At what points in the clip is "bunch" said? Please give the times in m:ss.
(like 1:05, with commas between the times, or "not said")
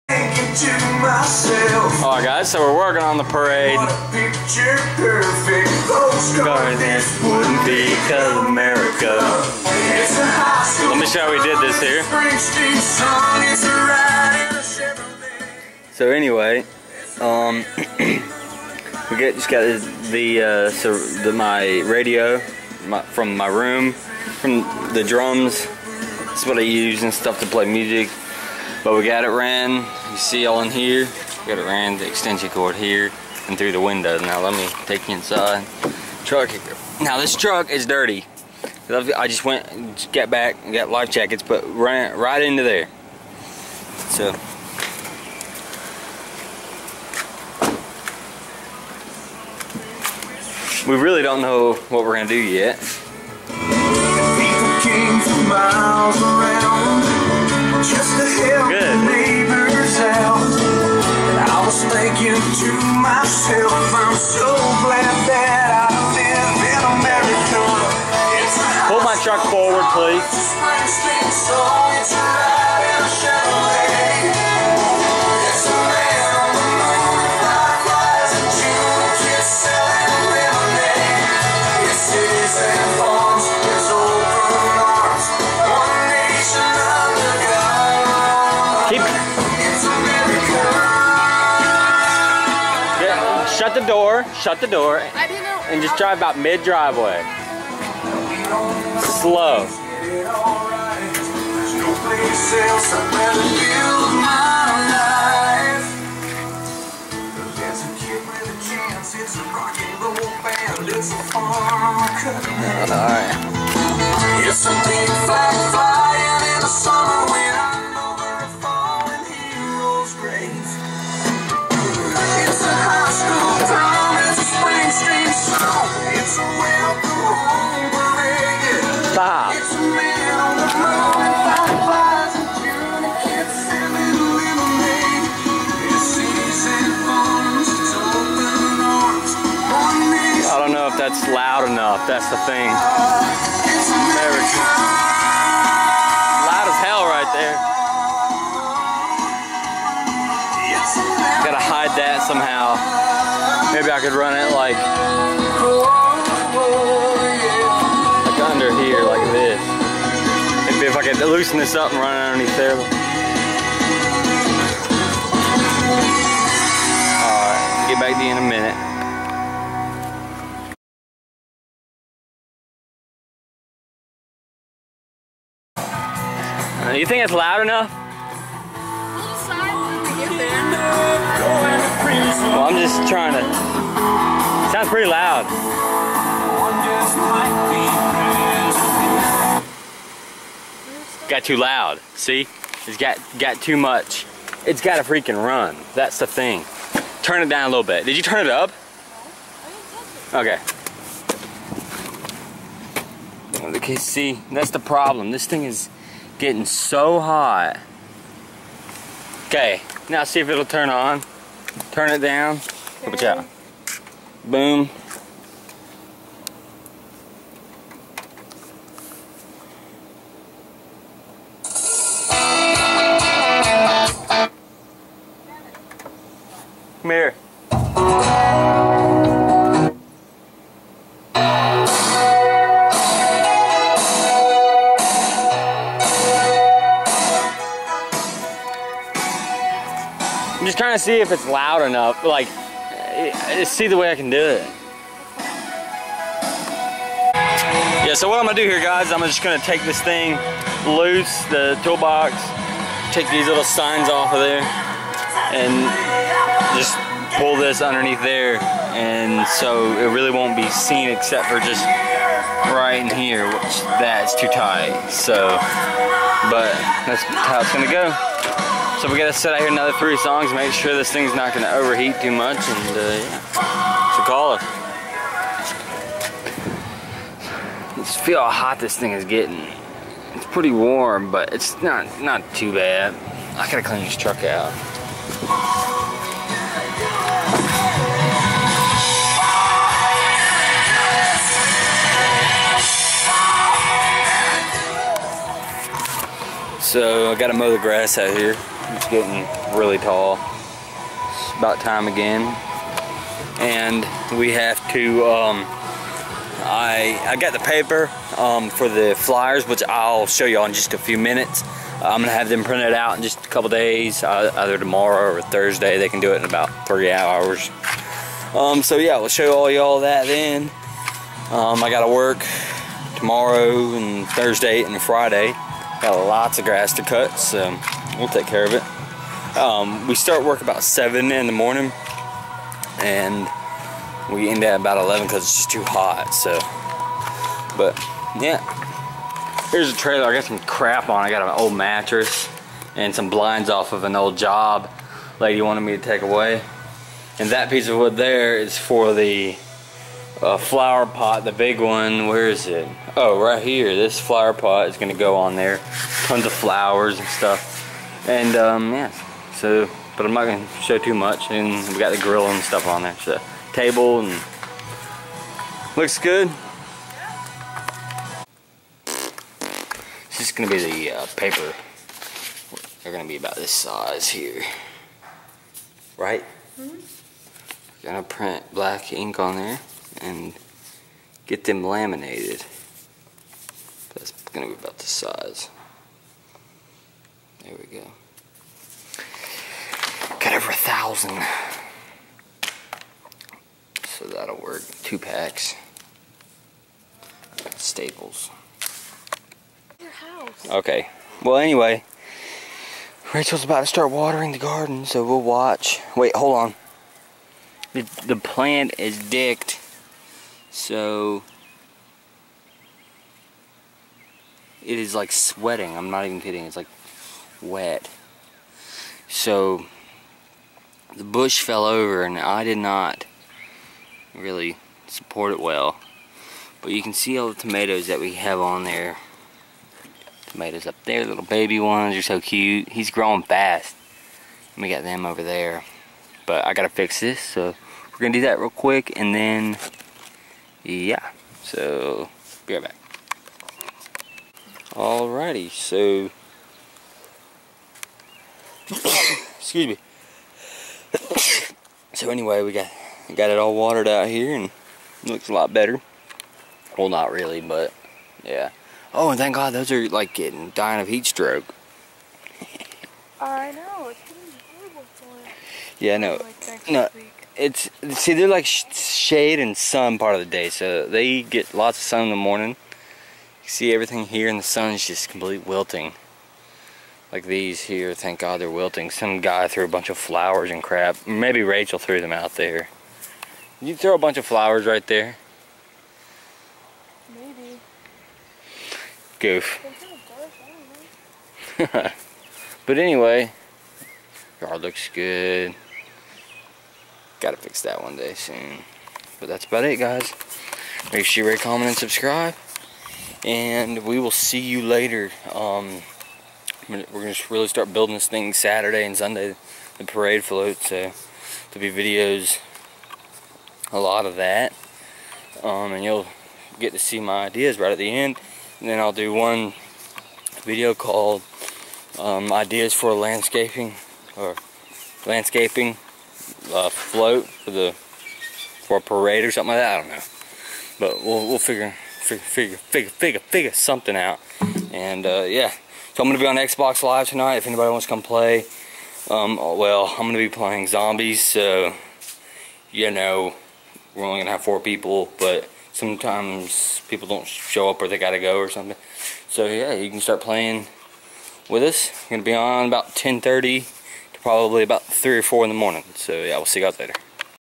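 7:59, 8:04.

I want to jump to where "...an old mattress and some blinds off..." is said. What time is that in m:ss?
5:41.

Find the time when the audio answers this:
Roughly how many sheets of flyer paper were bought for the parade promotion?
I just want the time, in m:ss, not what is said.
6:30.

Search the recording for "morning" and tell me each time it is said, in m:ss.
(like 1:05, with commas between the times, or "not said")
5:31, 7:52, 9:15.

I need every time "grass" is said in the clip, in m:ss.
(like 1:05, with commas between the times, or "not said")
4:57, 5:26.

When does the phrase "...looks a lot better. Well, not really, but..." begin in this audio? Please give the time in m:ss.
7:35.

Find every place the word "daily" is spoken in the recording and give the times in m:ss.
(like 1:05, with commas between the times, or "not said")
not said.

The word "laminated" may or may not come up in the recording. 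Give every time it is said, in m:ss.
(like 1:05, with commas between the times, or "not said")
6:21.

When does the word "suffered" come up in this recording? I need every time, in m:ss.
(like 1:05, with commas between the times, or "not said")
not said.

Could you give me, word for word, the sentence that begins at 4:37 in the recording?
Just feel how hot this thing is getting.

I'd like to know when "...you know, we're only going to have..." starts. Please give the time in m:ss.
9:02.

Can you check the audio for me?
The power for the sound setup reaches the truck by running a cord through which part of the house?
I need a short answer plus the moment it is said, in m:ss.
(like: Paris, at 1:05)
the window, at 0:33.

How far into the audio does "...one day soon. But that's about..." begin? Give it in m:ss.
8:18.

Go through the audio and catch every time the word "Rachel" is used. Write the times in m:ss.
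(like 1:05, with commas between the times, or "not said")
6:43, 8:01.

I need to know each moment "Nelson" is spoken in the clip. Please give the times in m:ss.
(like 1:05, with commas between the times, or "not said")
not said.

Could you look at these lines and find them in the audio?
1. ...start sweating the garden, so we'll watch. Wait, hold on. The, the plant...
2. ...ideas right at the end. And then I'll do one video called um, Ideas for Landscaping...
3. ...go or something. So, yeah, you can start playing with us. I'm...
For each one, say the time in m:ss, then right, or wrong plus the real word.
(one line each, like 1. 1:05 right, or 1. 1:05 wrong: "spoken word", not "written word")
1. 6:43 wrong: "watering", not "sweating"
2. 8:37 right
3. 9:08 right.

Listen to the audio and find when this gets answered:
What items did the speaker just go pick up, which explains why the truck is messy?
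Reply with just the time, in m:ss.
0:40.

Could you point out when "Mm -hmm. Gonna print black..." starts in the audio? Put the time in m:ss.
6:16.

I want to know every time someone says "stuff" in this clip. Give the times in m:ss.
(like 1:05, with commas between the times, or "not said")
0:27, 5:57, 6:02.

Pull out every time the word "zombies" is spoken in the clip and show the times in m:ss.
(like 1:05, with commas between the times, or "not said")
9:00.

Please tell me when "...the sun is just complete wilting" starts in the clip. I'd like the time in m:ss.
7:54.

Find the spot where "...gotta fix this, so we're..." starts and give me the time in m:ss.
7:16.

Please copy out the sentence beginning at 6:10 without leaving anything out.
This is gonna be the uh, paper.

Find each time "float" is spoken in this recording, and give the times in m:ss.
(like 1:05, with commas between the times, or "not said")
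8:30, 8:46.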